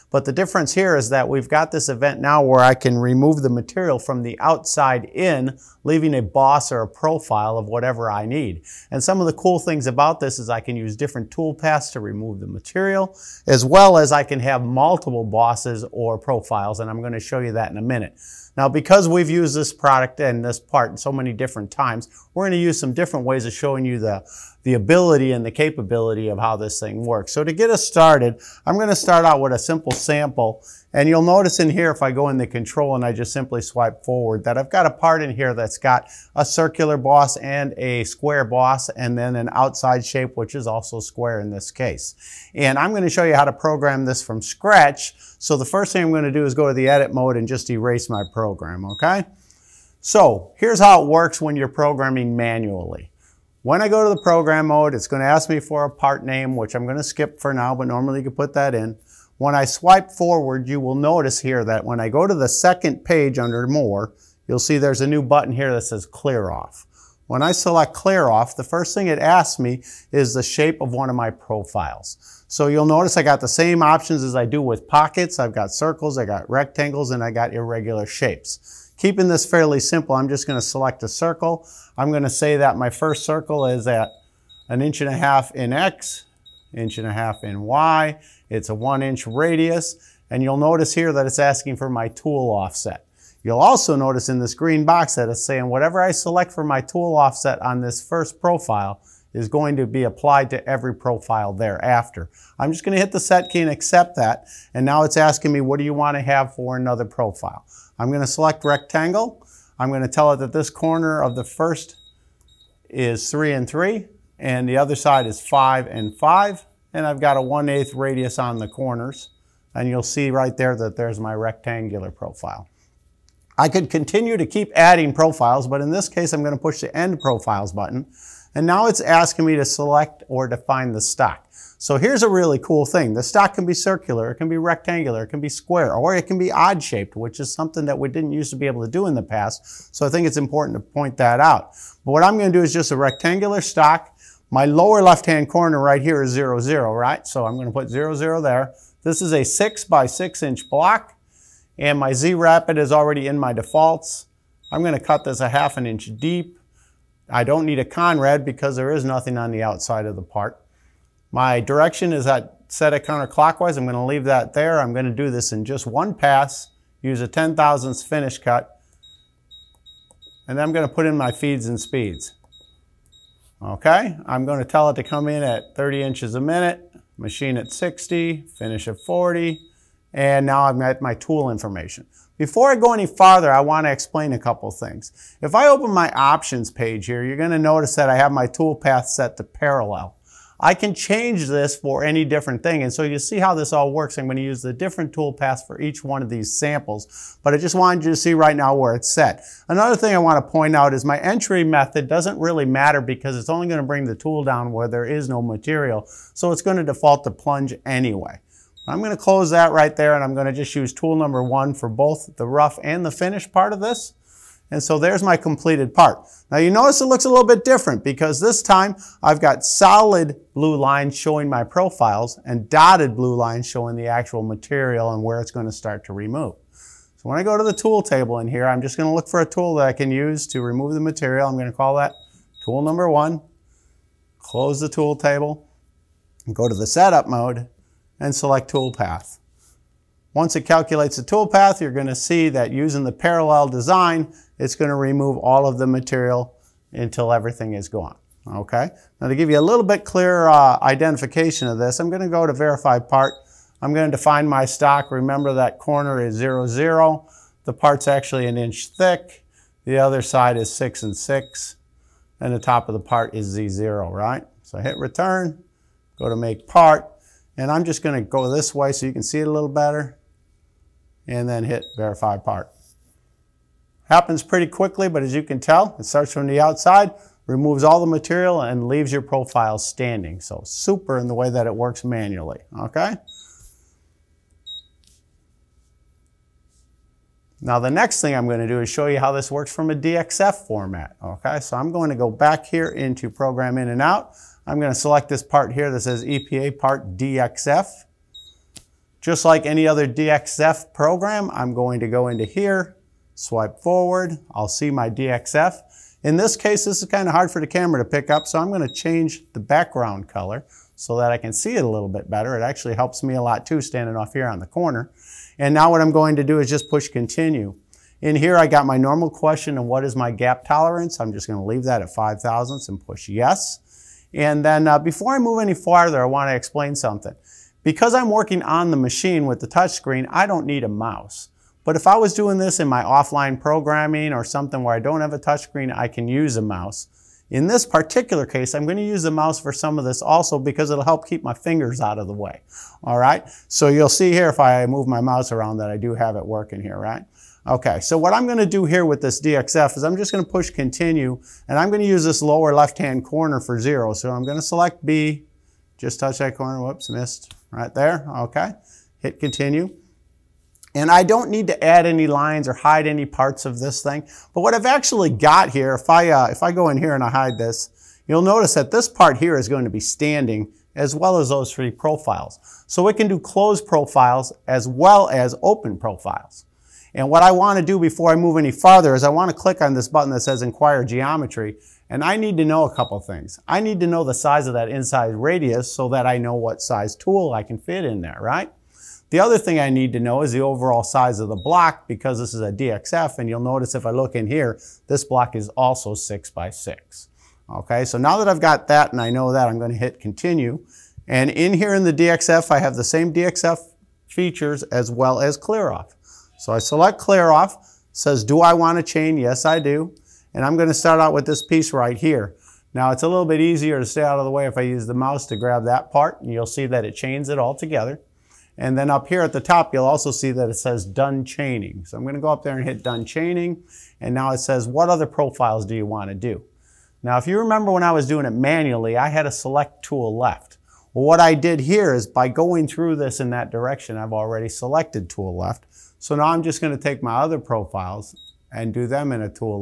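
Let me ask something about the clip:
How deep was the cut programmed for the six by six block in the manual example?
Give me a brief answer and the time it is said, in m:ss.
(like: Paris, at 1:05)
half an inch, at 2:35.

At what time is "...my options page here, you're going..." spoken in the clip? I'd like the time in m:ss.
3:05.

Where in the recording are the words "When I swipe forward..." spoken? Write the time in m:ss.
0:59.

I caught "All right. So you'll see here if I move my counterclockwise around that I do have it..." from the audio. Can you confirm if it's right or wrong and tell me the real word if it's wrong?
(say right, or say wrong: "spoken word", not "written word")
wrong: "mouse", not "counterclockwise".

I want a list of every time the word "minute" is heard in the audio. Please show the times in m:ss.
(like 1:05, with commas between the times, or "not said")
0:17, 2:56.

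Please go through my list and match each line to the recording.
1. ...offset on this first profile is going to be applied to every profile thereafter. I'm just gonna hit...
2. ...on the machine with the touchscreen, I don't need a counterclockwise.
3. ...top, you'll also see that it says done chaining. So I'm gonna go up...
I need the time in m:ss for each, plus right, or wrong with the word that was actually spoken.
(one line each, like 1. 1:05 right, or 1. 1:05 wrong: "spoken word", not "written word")
1. 1:37 right
2. 5:28 wrong: "mouse", not "counterclockwise"
3. 6:59 right.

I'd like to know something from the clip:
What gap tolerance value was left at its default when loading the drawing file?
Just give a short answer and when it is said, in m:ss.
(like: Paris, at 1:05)
5 thousandths, at 5:22.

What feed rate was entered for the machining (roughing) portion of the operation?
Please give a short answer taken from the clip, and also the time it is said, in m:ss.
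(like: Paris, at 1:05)
60, at 2:57.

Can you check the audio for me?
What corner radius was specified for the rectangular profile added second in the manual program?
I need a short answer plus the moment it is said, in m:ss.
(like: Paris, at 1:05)
1/8, at 1:57.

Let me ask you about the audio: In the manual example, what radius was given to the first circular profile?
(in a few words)
1 inch.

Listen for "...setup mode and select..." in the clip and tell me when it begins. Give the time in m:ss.
3:56.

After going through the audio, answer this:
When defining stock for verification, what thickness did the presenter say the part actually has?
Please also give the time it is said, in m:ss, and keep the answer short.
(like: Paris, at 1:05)
1 inch, at 4:18.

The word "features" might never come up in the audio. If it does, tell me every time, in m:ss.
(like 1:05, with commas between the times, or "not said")
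6:44.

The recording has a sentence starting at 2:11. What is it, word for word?
So here's a really cool thing.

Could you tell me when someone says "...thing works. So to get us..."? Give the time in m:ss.
0:26.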